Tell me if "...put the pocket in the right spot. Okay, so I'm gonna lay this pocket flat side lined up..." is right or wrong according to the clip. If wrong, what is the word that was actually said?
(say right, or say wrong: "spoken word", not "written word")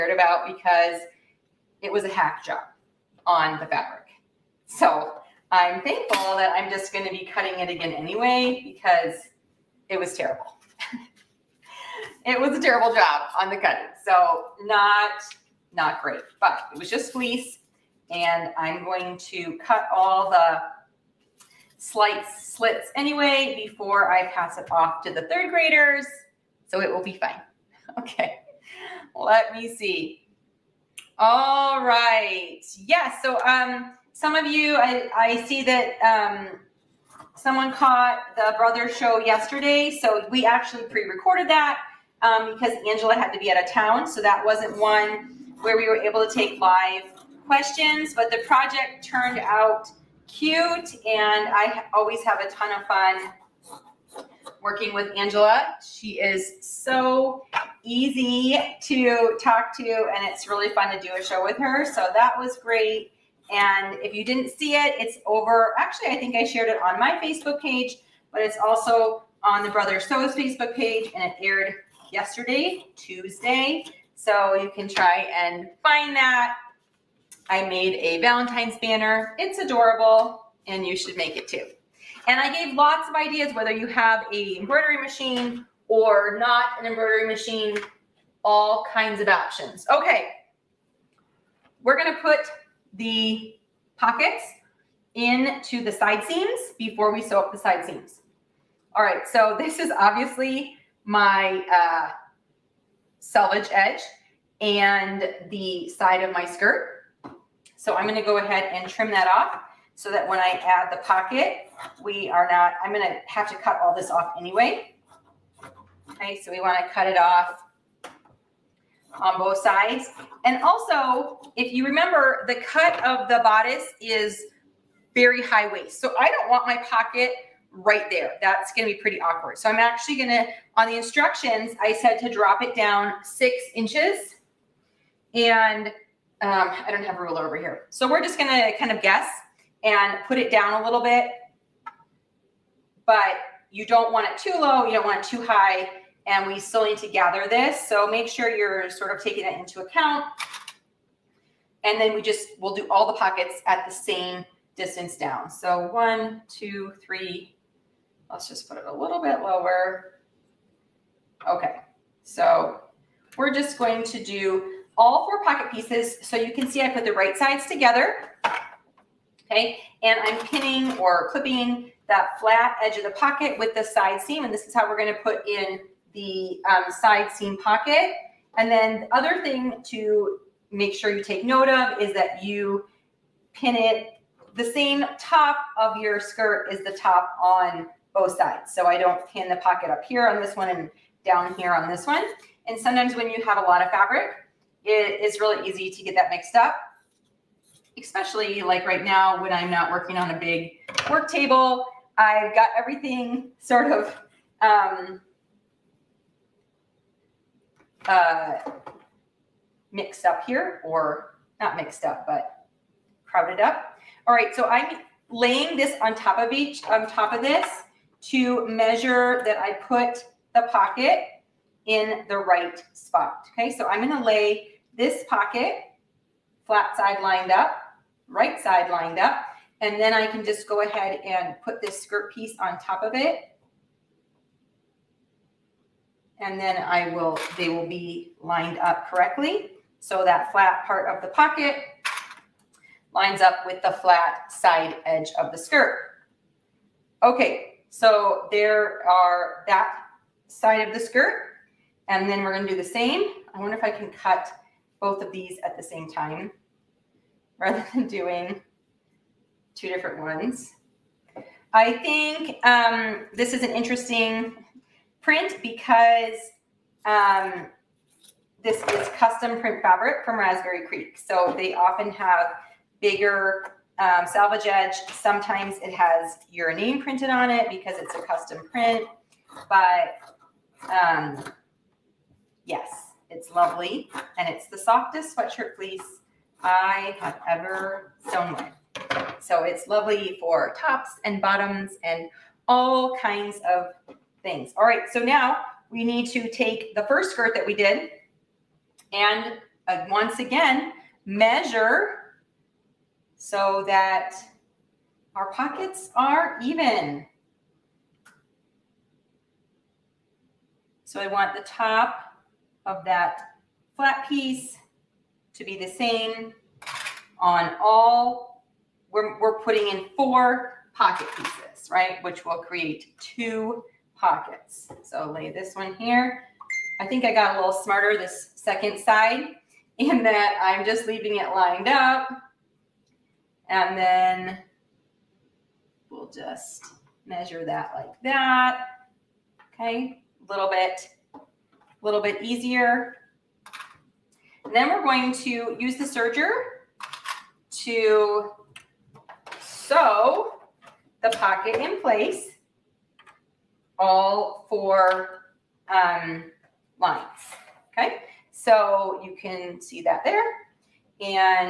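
right.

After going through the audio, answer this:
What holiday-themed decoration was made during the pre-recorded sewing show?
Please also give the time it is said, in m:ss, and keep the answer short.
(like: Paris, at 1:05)
Valentine's banner, at 1:18.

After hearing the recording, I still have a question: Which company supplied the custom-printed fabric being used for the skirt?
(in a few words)
Raspberry Creek.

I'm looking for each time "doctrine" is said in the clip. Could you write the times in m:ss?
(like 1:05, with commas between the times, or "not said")
not said.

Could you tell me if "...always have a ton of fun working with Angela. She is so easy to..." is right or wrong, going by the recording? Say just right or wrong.
right.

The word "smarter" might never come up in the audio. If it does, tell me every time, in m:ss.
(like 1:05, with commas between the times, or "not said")
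5:27.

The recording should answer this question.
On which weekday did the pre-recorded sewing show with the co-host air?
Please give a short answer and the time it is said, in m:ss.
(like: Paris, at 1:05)
Tuesday, at 1:12.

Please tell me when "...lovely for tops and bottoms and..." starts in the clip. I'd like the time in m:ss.
4:49.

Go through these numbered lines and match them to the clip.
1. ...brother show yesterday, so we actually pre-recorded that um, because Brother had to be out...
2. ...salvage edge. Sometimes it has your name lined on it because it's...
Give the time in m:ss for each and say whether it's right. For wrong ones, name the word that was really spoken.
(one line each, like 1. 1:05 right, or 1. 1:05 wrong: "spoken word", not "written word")
1. 0:38 wrong: "Angela", not "Brother"
2. 4:34 wrong: "printed", not "lined".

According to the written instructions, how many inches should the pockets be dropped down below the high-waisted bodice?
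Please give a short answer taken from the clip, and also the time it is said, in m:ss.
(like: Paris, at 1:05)
6 inches, at 2:13.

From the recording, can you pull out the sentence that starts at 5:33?
And then we'll just measure that like that.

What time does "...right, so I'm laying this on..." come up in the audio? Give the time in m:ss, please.
3:34.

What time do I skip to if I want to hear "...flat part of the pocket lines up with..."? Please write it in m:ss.
4:00.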